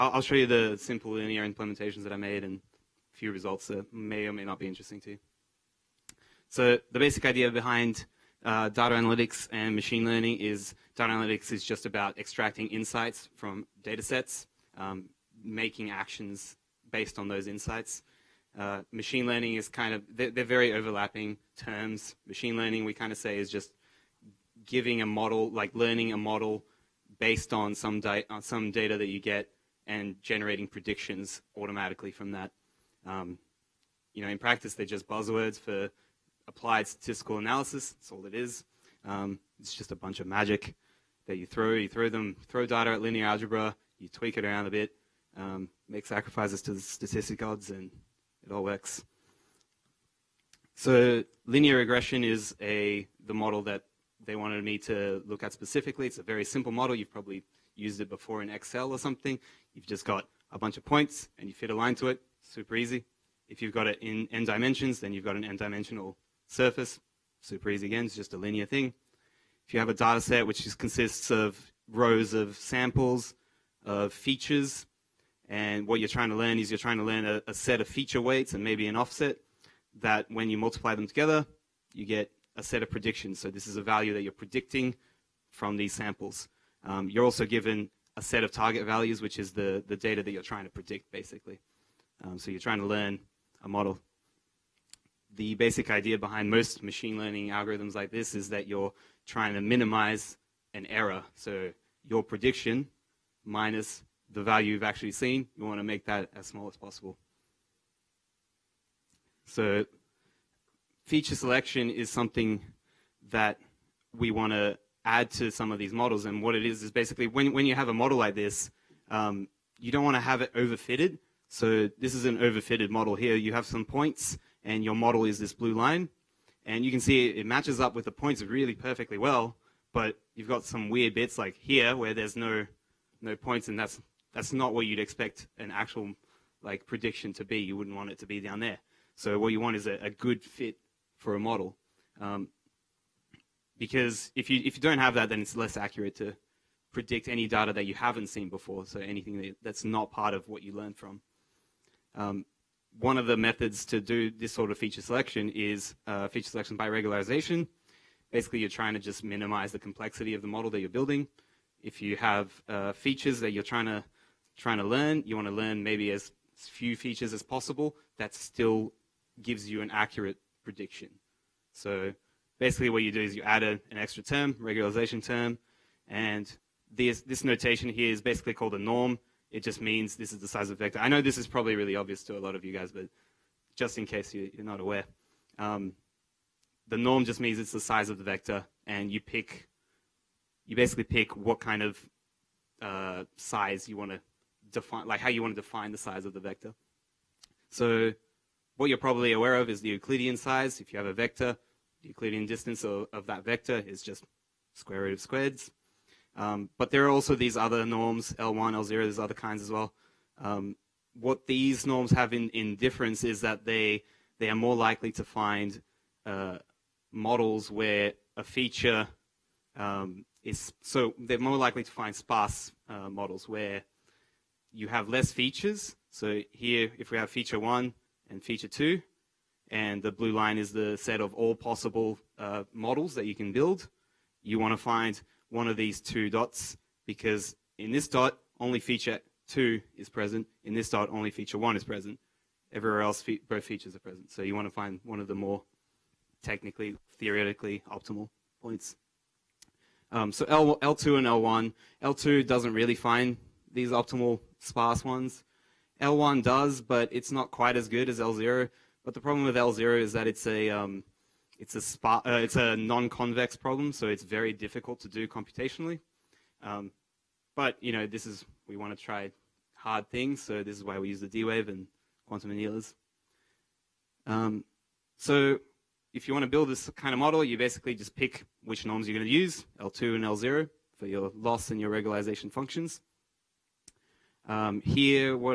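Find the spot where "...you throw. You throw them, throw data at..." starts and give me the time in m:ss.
0:41.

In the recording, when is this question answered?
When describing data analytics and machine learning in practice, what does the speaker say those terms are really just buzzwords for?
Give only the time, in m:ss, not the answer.
0:36.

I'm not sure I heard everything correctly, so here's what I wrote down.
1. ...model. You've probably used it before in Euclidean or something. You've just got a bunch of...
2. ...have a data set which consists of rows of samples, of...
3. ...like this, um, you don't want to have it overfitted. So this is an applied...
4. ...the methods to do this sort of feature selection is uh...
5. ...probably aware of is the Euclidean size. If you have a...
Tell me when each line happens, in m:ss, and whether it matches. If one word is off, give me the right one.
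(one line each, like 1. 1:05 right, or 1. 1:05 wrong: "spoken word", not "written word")
1. 0:56 wrong: "Excel", not "Euclidean"
2. 1:09 right
3. 1:58 wrong: "overfitted", not "applied"
4. 2:33 right
5. 3:18 right.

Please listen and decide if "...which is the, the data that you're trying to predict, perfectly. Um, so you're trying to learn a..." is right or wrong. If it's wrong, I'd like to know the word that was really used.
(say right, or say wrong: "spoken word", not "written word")
wrong: "basically", not "perfectly".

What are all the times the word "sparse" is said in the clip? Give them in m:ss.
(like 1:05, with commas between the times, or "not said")
3:42, 4:14.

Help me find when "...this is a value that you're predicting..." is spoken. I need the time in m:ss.
1:23.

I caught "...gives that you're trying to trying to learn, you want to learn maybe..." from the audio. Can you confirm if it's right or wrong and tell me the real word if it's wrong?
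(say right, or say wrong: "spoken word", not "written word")
wrong: "features", not "gives".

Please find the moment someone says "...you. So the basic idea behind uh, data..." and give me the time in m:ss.
0:05.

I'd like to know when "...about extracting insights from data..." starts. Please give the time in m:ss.
0:11.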